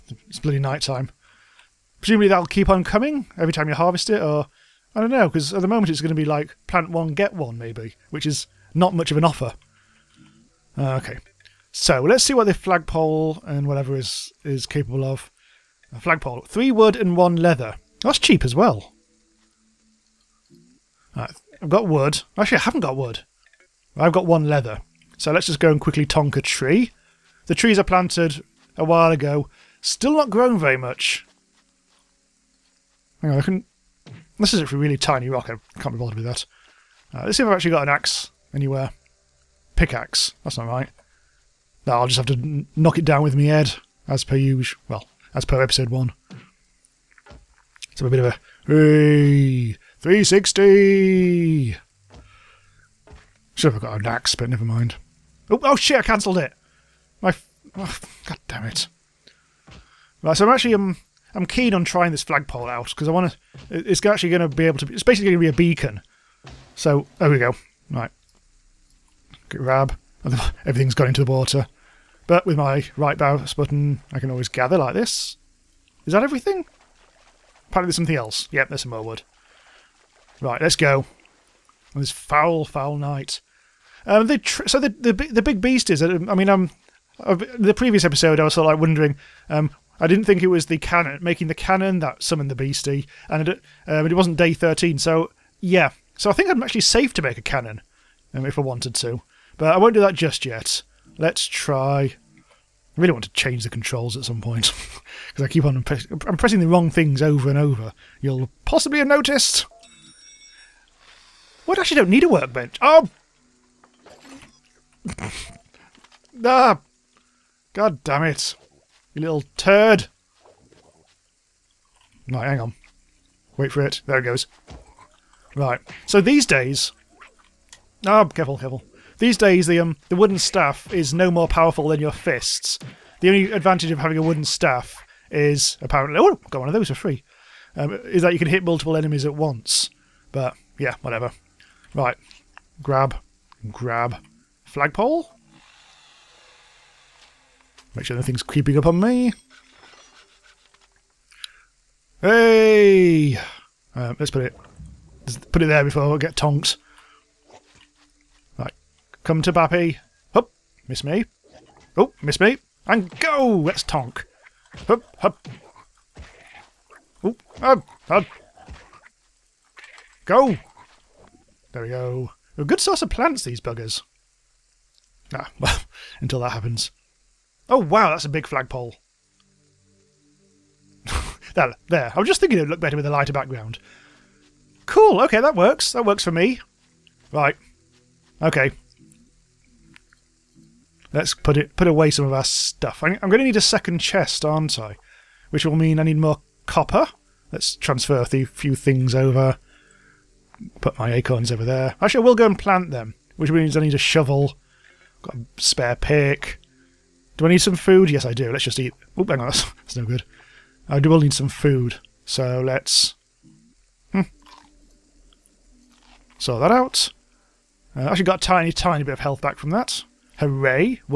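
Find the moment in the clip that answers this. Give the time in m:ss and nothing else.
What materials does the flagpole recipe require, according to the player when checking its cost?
0:16.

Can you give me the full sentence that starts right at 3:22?
Actually, I will go and plant them, which means I need a shovel.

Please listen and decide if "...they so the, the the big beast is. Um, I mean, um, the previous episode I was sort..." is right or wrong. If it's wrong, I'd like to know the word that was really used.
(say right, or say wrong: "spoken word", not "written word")
right.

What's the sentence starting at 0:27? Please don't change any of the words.
The trees are planted a while ago.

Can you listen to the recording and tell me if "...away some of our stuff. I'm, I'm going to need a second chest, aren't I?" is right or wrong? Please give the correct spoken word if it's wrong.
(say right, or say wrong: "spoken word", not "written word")
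right.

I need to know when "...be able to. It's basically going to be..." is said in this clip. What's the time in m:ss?
1:04.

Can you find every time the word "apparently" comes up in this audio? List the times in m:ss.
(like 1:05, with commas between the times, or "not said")
1:17, 2:15.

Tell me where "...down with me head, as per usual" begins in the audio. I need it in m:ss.
0:43.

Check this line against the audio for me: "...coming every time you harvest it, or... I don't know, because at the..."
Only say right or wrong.
right.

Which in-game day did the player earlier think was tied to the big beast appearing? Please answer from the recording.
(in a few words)
Day 13.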